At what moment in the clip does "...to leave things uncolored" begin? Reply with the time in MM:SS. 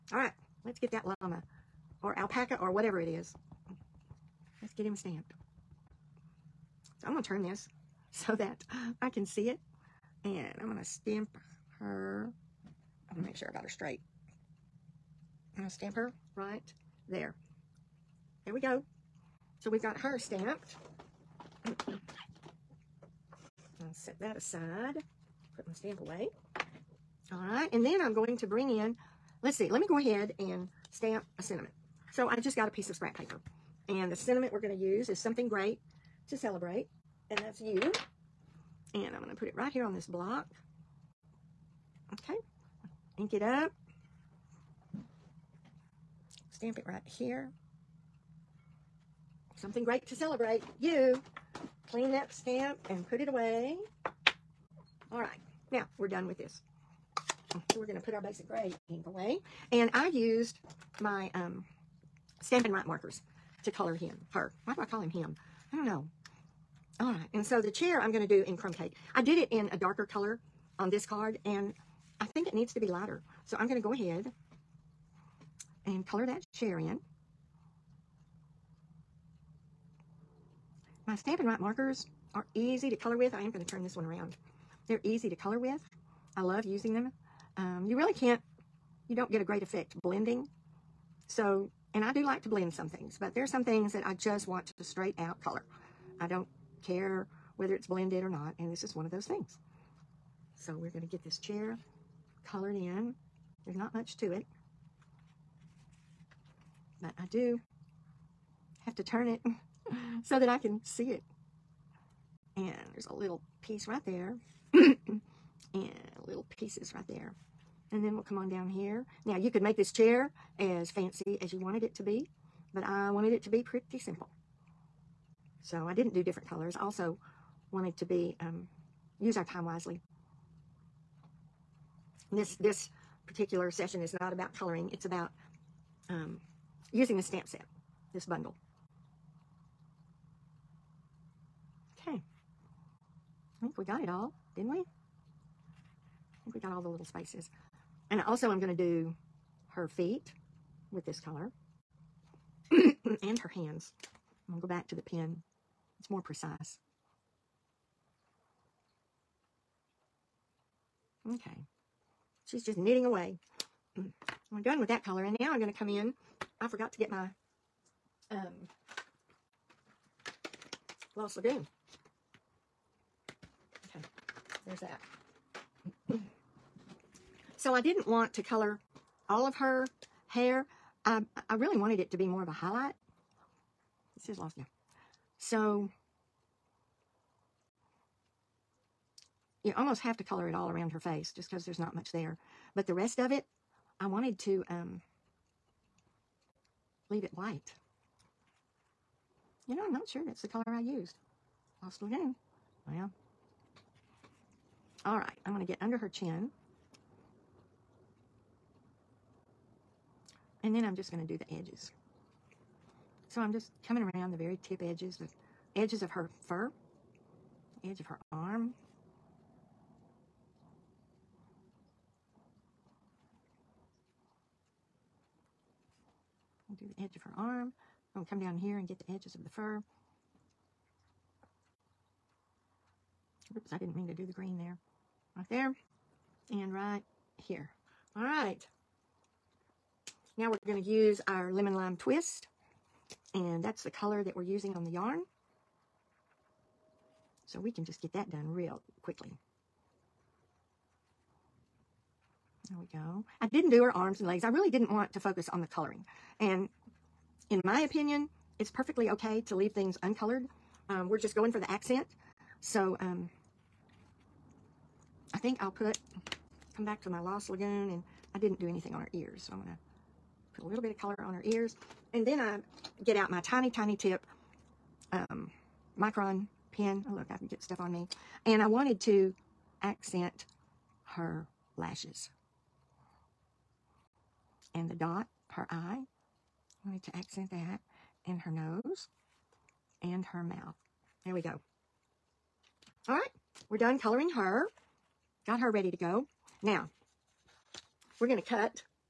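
04:19.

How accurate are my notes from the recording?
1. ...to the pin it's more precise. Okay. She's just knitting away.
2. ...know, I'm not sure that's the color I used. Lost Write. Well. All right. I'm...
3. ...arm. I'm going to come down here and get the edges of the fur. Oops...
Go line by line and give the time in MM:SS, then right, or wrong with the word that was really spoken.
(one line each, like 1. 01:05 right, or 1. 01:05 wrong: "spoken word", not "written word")
1. 02:34 right
2. 03:19 wrong: "Lagoon", not "Write"
3. 03:47 right.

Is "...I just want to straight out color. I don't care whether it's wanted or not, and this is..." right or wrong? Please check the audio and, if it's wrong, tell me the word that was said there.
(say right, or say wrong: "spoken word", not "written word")
wrong: "blended", not "wanted".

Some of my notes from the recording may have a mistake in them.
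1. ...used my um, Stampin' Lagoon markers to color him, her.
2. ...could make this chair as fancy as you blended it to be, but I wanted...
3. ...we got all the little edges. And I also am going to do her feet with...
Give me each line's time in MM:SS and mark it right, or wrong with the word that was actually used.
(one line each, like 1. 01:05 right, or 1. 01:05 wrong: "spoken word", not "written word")
1. 01:00 wrong: "Write", not "Lagoon"
2. 01:59 wrong: "wanted", not "blended"
3. 02:26 wrong: "spaces", not "edges".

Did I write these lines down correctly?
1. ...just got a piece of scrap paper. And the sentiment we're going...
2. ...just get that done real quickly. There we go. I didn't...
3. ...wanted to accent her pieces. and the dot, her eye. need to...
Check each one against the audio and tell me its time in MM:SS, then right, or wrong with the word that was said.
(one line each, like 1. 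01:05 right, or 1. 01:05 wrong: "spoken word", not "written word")
1. 00:32 right
2. 04:07 right
3. 04:38 wrong: "lashes", not "pieces".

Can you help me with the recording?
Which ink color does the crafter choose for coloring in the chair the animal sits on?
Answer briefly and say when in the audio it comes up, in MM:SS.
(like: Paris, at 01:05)
Crumb Cake, at 01:08.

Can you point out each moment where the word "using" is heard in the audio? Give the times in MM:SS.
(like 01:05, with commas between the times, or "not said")
01:26, 02:16, 04:04.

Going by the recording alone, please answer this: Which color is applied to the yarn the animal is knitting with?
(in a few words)
Lemon Lime Twist.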